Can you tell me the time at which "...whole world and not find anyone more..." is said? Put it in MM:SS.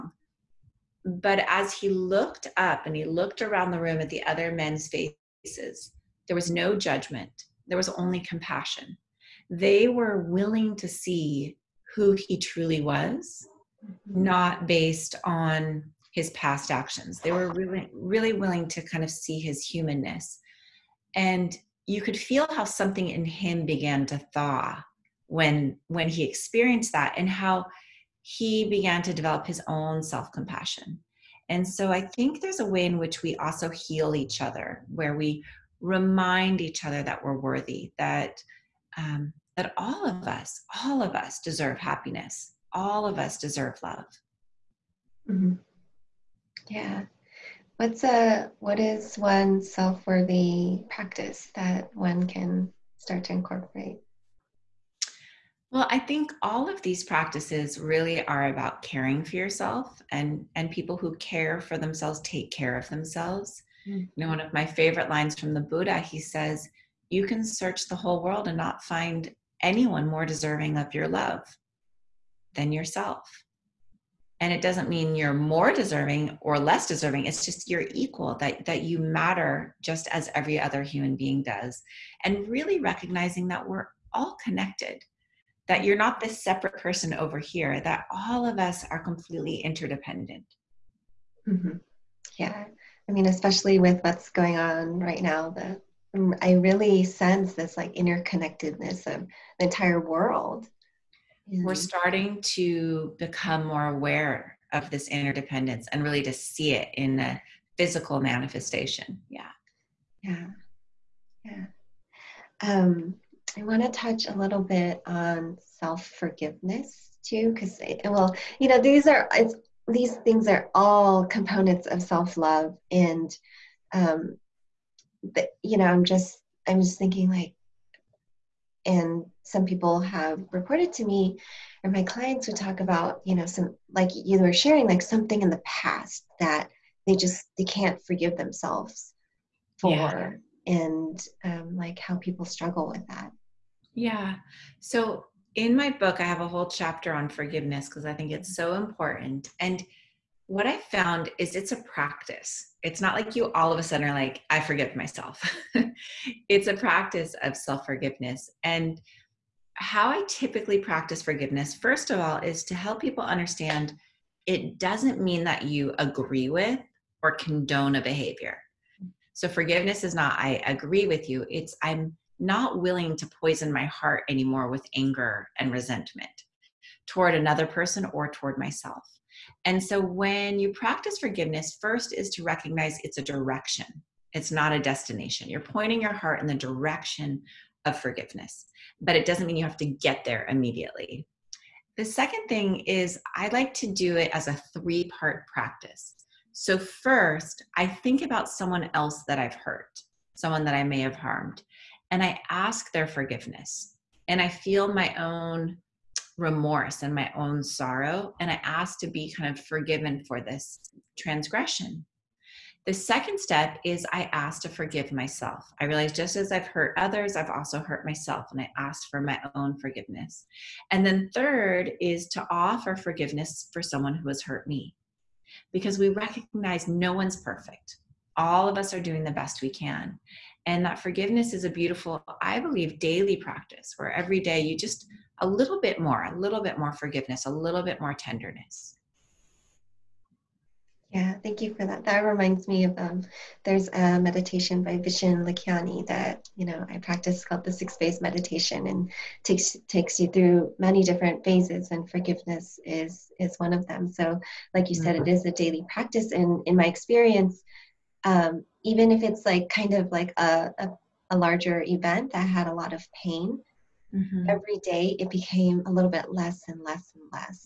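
01:07.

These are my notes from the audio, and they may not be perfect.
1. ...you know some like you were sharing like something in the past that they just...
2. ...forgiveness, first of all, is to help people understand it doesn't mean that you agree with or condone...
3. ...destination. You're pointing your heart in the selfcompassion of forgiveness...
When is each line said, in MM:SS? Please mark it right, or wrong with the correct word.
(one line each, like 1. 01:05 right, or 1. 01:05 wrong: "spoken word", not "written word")
1. 02:13 right
2. 02:41 right
3. 03:04 wrong: "direction", not "selfcompassion".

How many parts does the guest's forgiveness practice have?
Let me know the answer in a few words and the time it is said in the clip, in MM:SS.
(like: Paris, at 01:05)
3, at 03:14.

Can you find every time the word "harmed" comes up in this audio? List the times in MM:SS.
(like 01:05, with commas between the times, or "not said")
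03:21.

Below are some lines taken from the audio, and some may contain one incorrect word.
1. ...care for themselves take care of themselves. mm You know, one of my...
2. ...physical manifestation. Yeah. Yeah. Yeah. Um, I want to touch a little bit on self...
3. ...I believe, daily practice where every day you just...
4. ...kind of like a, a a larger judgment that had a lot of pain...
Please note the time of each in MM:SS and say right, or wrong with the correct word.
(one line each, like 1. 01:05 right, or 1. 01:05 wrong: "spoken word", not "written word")
1. 01:01 right
2. 01:47 right
3. 03:52 right
4. 04:19 wrong: "event", not "judgment".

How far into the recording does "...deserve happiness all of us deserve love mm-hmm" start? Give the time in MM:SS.
00:41.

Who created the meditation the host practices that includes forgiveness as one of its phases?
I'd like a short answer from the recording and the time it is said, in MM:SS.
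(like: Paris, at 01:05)
Vishen Lakhiani, at 04:04.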